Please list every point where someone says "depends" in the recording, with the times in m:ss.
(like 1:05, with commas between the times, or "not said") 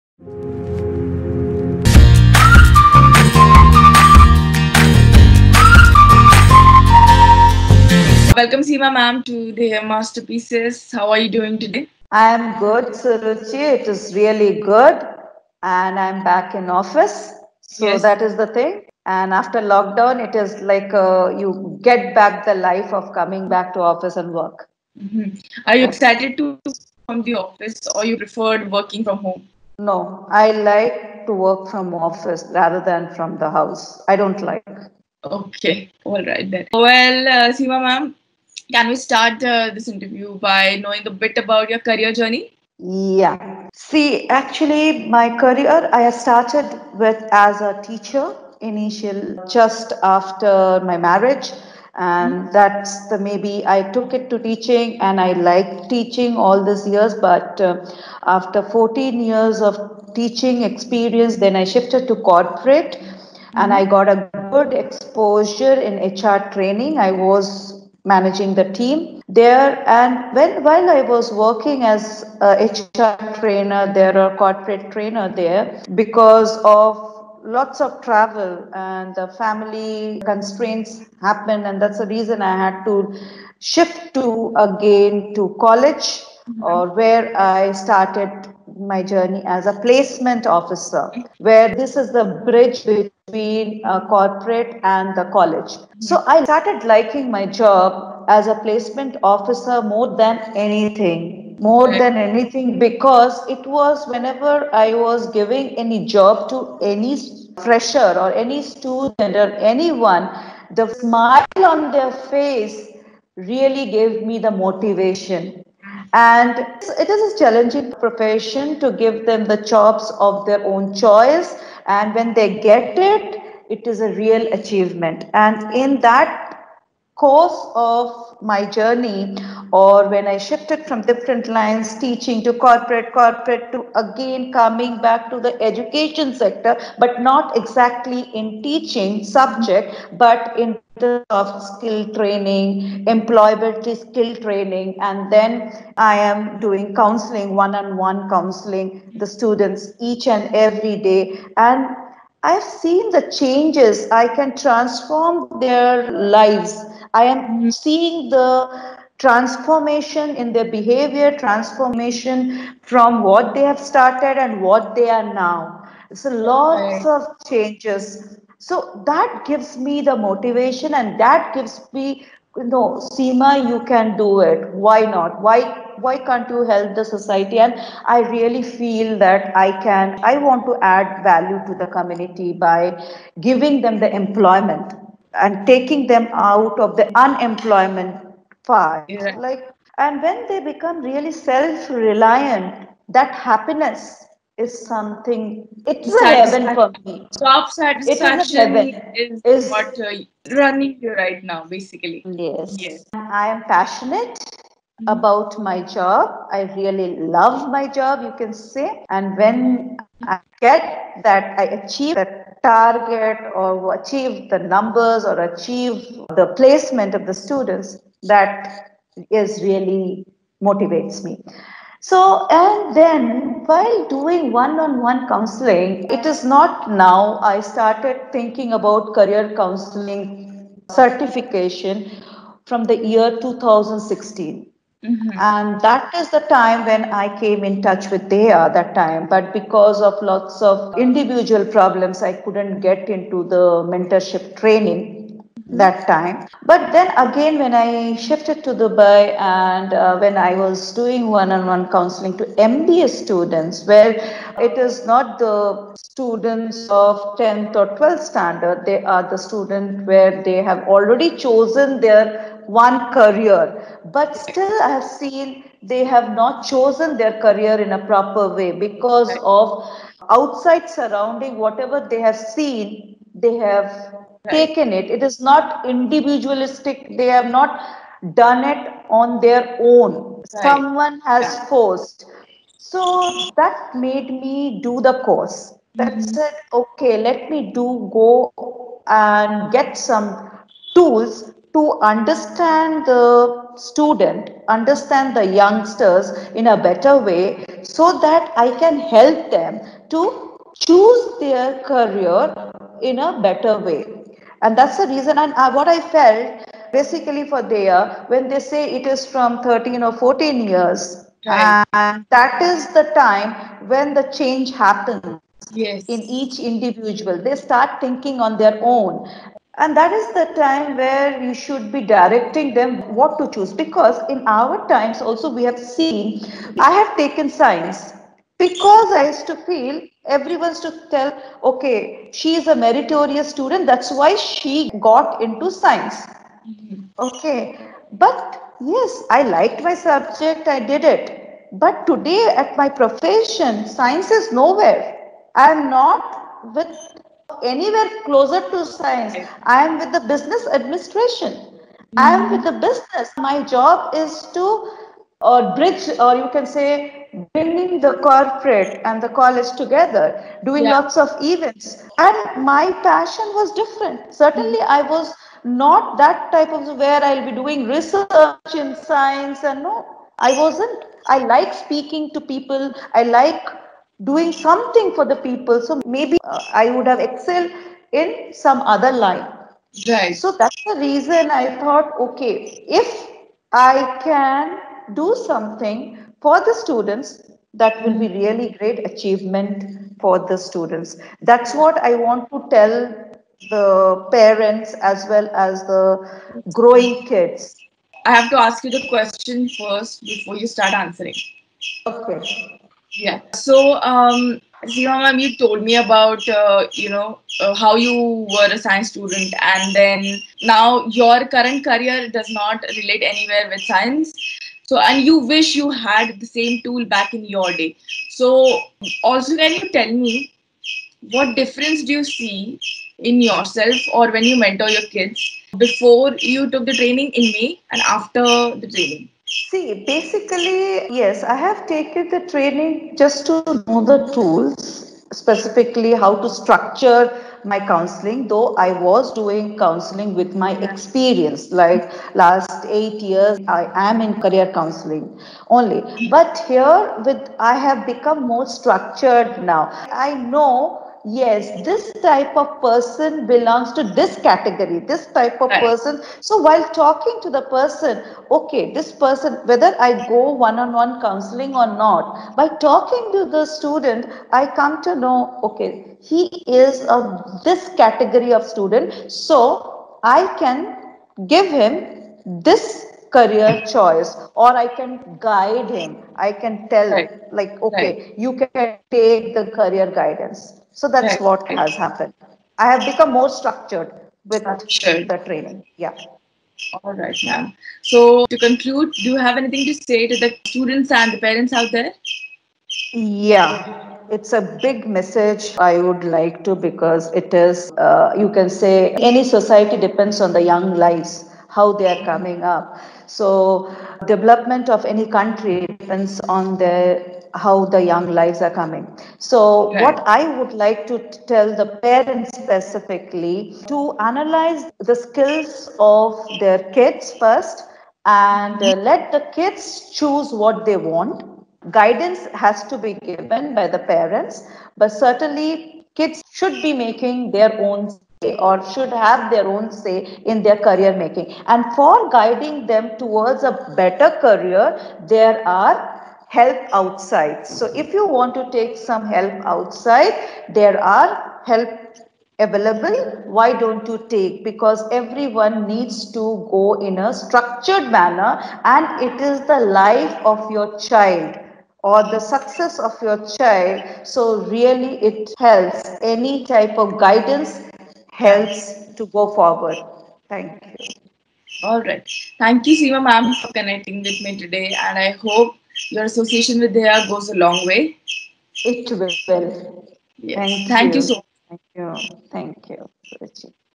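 8:19, 8:25.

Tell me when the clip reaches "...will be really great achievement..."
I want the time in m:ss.
6:28.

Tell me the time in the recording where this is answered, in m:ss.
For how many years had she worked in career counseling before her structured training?
7:22.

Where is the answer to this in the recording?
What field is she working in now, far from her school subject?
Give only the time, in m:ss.
5:50.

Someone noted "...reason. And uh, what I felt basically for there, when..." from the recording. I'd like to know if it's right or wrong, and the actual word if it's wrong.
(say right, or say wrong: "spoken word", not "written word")
right.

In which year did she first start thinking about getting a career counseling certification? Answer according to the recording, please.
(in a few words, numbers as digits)
2016.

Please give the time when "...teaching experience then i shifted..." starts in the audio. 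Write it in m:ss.
1:00.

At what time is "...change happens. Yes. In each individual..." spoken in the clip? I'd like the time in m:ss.
5:14.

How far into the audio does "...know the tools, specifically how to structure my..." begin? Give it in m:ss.
7:13.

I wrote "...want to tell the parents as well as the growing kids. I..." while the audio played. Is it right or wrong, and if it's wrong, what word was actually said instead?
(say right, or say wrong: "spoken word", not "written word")
right.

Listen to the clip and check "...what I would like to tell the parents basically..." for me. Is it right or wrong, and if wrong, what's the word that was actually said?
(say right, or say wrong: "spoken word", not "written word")
wrong: "specifically", not "basically".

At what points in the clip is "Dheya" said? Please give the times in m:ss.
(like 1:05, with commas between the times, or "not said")
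3:58, 9:26.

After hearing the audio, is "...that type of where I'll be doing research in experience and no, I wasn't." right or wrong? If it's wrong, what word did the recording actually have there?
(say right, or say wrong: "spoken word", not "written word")
wrong: "science", not "experience".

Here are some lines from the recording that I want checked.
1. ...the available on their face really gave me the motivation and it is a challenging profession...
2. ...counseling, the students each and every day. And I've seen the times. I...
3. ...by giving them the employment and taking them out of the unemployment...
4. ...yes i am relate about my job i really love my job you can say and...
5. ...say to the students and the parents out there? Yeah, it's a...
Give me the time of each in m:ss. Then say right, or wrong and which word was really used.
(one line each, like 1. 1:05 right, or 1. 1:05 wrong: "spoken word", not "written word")
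1. 1:50 wrong: "smile", not "available"
2. 2:28 wrong: "changes", not "times"
3. 3:02 right
4. 3:22 wrong: "passionate", not "relate"
5. 8:10 right.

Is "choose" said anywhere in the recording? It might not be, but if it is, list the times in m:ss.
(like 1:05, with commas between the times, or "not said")
5:00, 5:23, 8:40.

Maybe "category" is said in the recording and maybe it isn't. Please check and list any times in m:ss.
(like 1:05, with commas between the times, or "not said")
7:34, 7:47.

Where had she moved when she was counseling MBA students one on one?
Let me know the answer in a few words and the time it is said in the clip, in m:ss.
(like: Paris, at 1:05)
Dubai, at 4:08.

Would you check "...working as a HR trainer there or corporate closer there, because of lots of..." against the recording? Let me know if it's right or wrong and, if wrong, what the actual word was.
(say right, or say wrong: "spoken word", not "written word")
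wrong: "trainer", not "closer".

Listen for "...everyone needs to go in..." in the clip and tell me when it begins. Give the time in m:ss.
9:05.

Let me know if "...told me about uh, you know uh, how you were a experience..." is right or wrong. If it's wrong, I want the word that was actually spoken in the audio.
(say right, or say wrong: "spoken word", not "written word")
wrong: "science", not "experience".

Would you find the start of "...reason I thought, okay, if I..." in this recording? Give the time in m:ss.
6:20.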